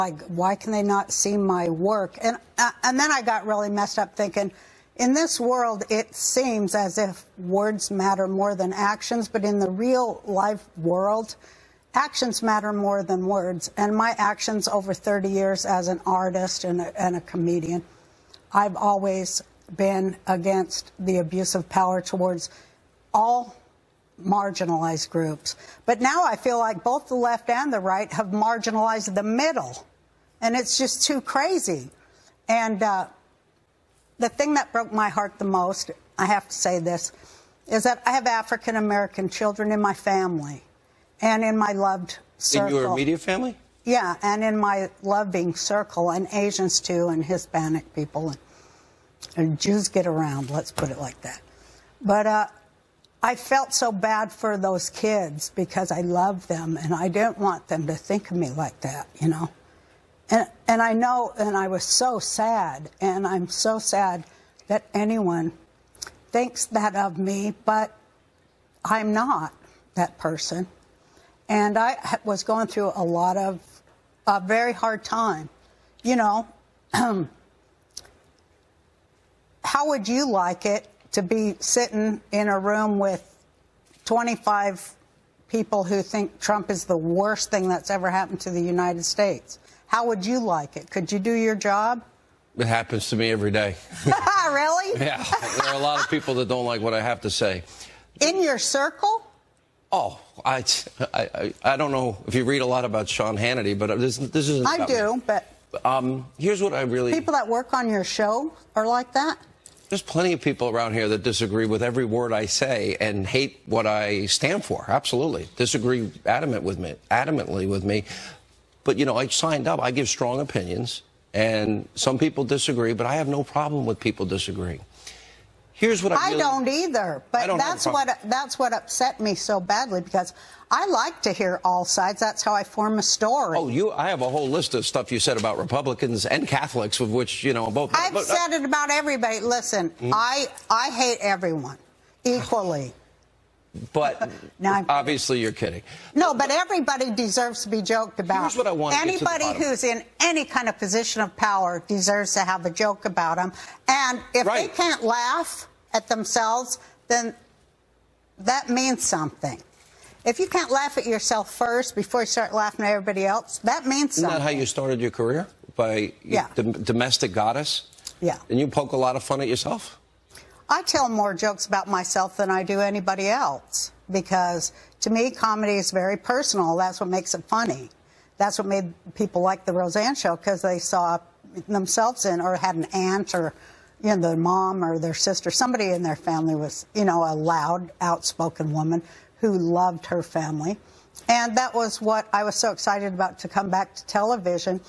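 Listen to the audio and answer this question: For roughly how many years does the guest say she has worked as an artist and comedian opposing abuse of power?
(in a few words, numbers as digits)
30.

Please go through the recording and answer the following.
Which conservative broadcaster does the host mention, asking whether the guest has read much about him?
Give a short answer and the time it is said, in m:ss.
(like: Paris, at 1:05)
Sean Hannity, at 1:43.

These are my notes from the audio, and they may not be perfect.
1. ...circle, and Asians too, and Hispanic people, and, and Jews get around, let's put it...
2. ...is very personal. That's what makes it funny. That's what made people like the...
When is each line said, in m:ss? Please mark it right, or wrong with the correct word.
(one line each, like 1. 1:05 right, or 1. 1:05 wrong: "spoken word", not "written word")
1. 0:45 right
2. 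2:55 right.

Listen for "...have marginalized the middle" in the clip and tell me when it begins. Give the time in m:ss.
0:28.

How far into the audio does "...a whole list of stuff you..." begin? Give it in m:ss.
2:14.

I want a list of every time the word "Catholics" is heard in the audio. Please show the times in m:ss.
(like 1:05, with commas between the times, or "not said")
2:16.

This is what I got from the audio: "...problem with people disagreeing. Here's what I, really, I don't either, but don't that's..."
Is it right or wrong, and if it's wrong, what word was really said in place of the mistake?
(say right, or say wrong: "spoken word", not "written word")
right.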